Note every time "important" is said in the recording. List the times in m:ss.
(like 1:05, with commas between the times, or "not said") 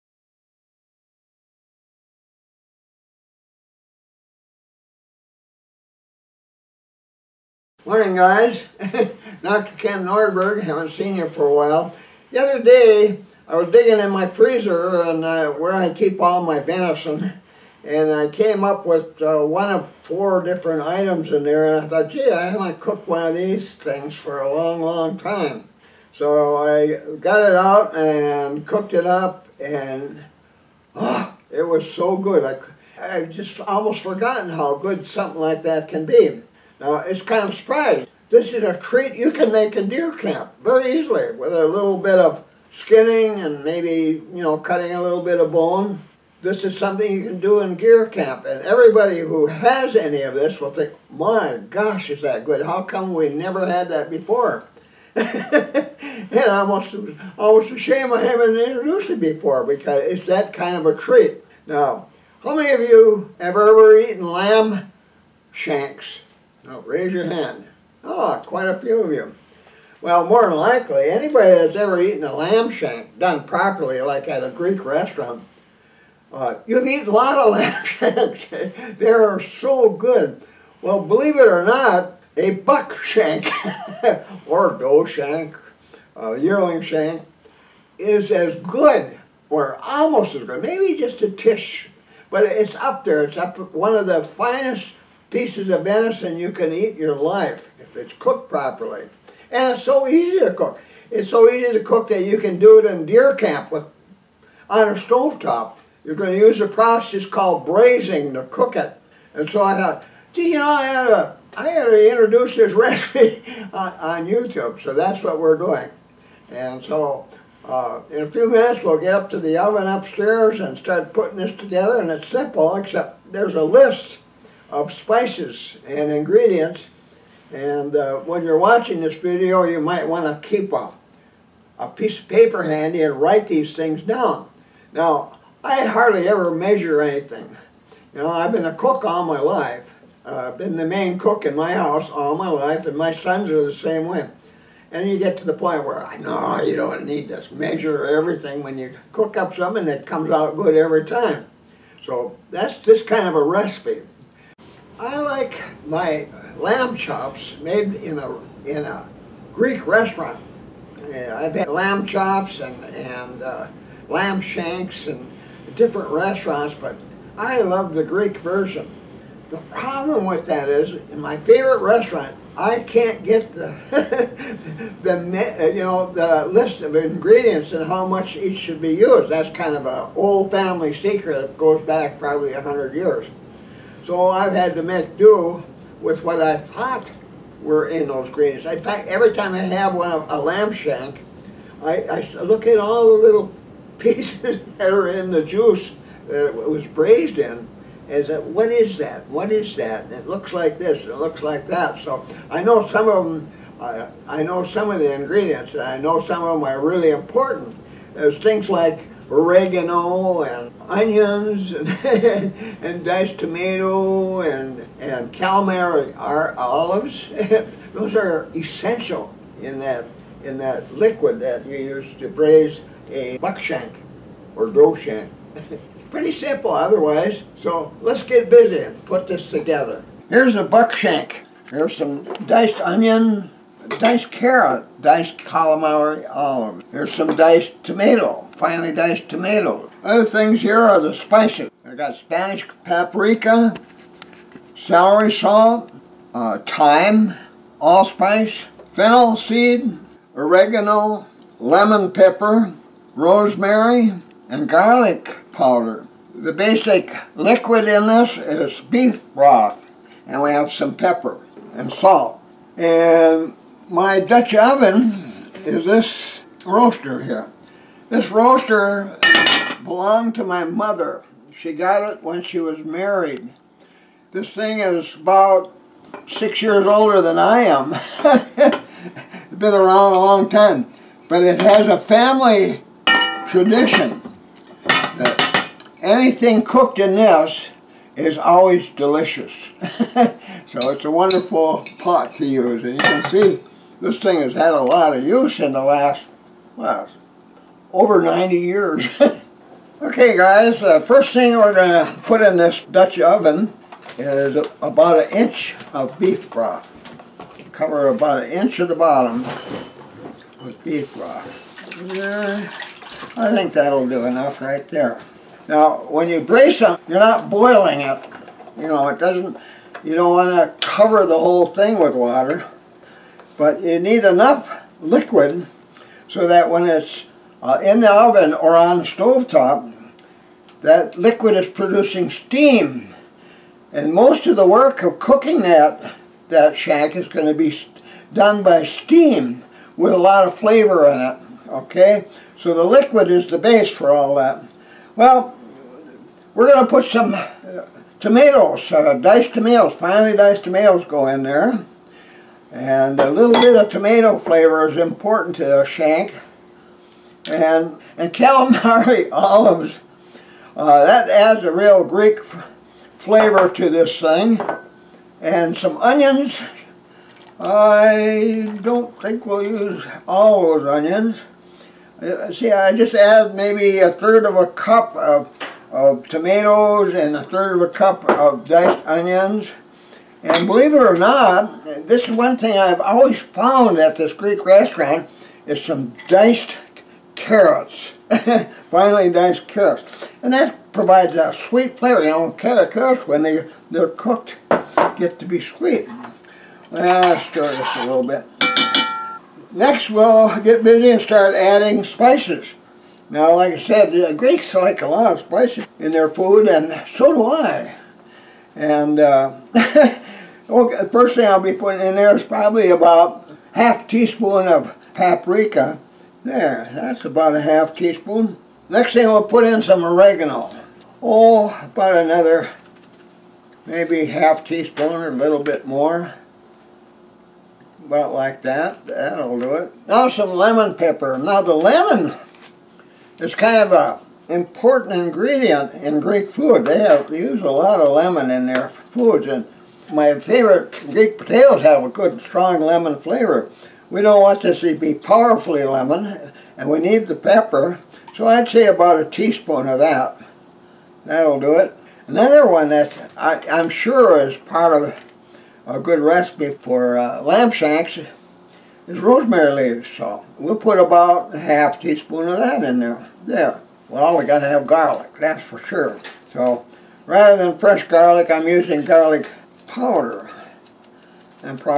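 3:27, 5:54, 7:14.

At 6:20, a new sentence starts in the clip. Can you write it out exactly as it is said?
And believe it or not, this is one thing I've always found at this Greek restaurant, is some diced carrots.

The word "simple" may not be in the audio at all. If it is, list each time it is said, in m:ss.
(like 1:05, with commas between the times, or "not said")
2:02, 3:46.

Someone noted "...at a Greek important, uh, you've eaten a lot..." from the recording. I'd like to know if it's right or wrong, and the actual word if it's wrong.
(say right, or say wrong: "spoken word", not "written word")
wrong: "restaurant", not "important".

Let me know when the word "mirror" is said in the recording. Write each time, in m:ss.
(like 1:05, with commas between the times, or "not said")
not said.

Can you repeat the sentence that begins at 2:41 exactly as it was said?
I've had lamb chops and and uh, lamb shanks and different restaurants, but I love the Greek version.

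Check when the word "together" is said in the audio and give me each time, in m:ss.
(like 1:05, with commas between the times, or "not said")
2:01, 3:49.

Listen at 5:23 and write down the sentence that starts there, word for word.
But you need enough liquid so that when it's uh, in the oven or on the stovetop, that liquid is producing steam.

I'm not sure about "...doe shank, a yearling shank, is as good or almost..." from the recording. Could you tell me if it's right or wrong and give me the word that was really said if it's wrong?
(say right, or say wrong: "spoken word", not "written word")
right.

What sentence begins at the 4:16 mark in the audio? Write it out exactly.
The basic liquid in this is beef broth, and we have some pepper and salt.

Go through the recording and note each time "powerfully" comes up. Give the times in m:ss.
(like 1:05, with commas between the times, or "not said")
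7:25.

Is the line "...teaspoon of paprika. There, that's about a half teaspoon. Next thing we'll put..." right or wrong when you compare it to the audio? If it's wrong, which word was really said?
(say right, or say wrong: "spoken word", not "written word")
right.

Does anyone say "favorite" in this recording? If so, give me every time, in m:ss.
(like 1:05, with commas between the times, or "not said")
2:51, 7:20.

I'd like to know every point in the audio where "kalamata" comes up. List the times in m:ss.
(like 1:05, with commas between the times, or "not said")
3:35, 3:55, 5:58.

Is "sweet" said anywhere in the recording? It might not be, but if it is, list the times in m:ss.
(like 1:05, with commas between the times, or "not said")
6:31, 6:35.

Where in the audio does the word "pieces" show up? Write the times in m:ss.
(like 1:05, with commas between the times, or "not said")
1:35, 2:11, 3:13.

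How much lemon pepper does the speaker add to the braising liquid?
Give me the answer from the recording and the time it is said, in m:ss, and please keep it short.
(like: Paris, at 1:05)
About 1 teaspoon, at 7:28.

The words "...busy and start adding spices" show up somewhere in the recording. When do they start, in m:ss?
6:40.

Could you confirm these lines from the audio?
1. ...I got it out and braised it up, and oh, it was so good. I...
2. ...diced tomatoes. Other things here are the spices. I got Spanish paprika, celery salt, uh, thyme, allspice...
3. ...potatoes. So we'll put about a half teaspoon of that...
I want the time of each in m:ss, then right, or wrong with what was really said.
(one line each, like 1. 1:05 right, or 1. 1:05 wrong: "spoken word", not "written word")
1. 0:26 wrong: "cooked", not "braised"
2. 3:58 right
3. 7:39 wrong: "leaves", not "potatoes".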